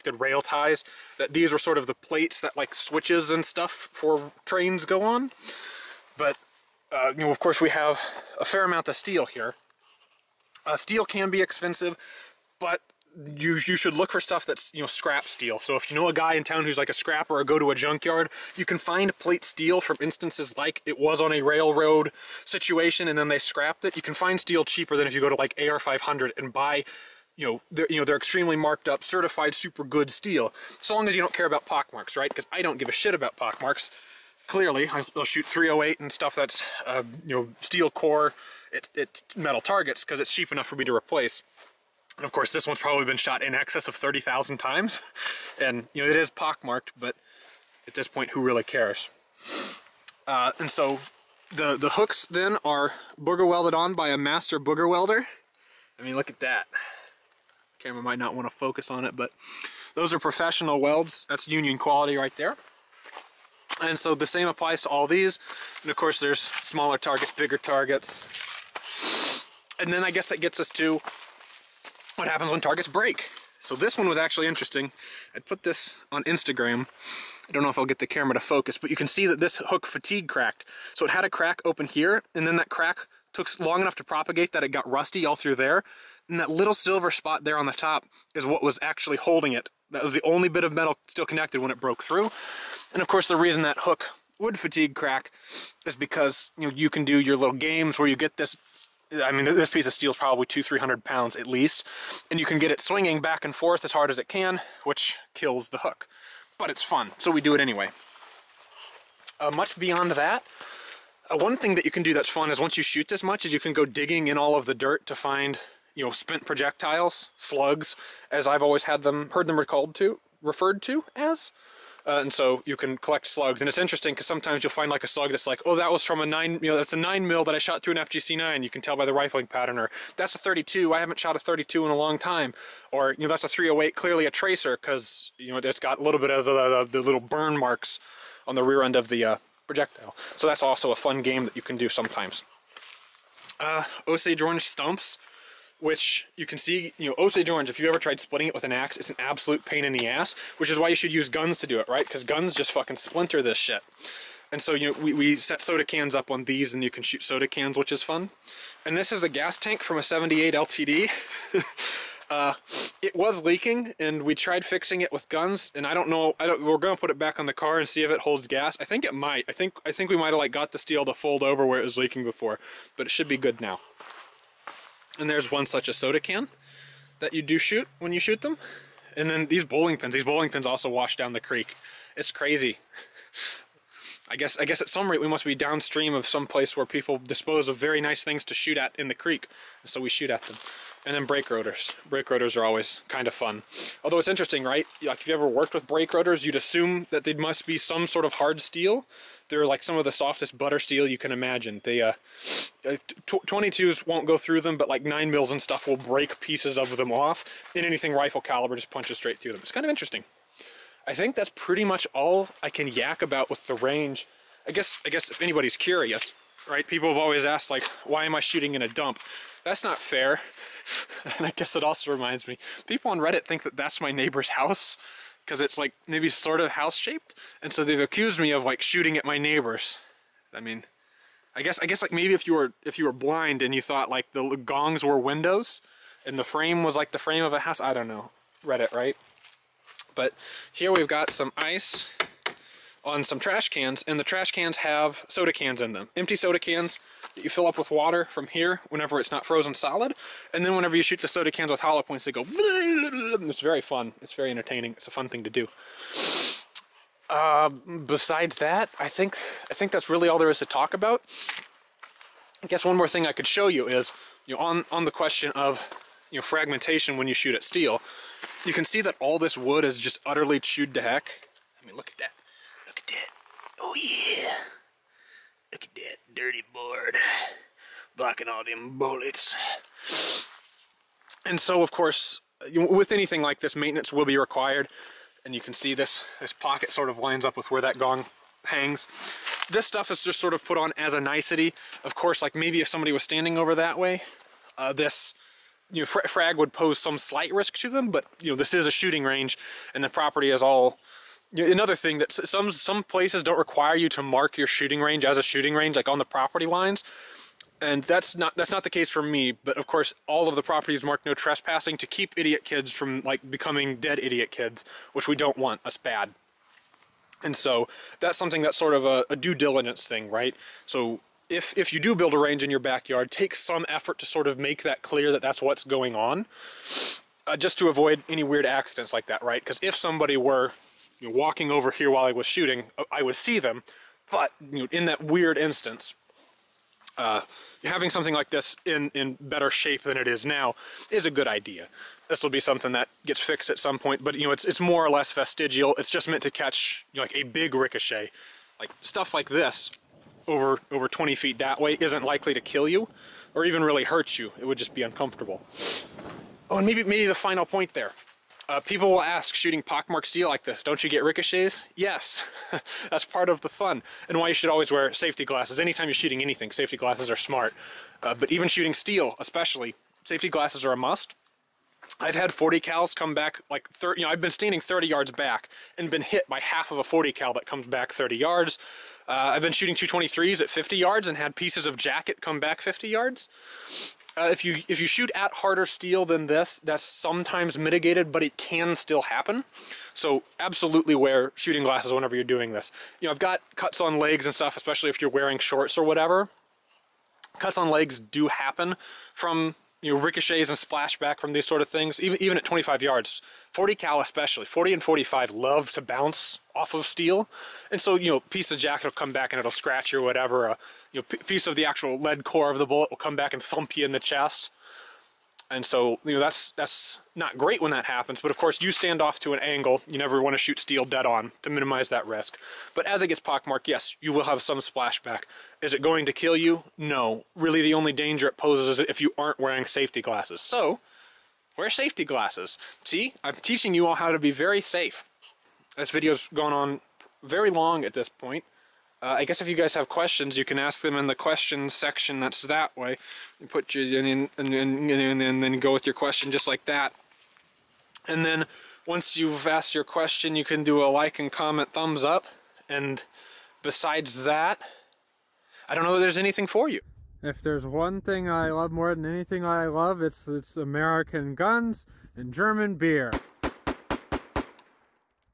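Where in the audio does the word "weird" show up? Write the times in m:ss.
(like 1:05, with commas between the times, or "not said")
5:28, 5:35.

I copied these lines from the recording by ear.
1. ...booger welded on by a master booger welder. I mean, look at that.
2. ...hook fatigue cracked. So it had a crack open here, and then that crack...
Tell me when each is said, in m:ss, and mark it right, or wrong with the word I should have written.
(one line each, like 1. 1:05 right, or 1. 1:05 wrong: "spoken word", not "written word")
1. 0:53 right
2. 1:19 right.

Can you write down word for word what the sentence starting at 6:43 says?
40 cal especially, 40 and 45 love to bounce off of steel.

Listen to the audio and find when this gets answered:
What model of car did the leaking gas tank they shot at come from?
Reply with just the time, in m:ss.
2:40.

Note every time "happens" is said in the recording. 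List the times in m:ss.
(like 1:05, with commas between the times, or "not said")
1:12, 6:29, 6:38, 6:58.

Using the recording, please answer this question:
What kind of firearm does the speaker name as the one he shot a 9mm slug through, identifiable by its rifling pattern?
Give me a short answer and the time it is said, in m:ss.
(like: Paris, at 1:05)
FGC9, at 2:07.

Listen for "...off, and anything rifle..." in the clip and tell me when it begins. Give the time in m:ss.
3:27.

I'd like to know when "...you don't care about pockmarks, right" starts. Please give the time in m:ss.
0:31.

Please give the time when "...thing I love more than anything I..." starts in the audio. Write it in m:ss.
7:38.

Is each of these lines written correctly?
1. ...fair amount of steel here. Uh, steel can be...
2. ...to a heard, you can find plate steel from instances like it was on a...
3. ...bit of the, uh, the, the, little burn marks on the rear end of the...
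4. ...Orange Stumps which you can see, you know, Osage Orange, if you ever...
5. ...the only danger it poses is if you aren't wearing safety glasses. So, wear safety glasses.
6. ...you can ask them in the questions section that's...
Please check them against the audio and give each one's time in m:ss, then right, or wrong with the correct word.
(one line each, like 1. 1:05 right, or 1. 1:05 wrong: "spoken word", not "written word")
1. 0:08 right
2. 0:17 wrong: "junkyard", not "heard"
3. 2:16 right
4. 2:24 right
5. 7:07 right
6. 7:20 right.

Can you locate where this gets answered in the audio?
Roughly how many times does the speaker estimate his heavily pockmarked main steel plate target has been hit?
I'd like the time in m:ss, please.
0:43.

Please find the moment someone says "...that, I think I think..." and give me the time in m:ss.
4:18.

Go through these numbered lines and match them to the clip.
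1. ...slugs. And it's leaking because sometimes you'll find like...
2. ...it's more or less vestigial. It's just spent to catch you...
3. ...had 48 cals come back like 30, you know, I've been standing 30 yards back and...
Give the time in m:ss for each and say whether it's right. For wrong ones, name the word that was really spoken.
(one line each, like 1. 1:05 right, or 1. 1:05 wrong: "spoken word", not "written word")
1. 2:03 wrong: "interesting", not "leaking"
2. 5:44 wrong: "meant", not "spent"
3. 6:12 wrong: "40", not "48".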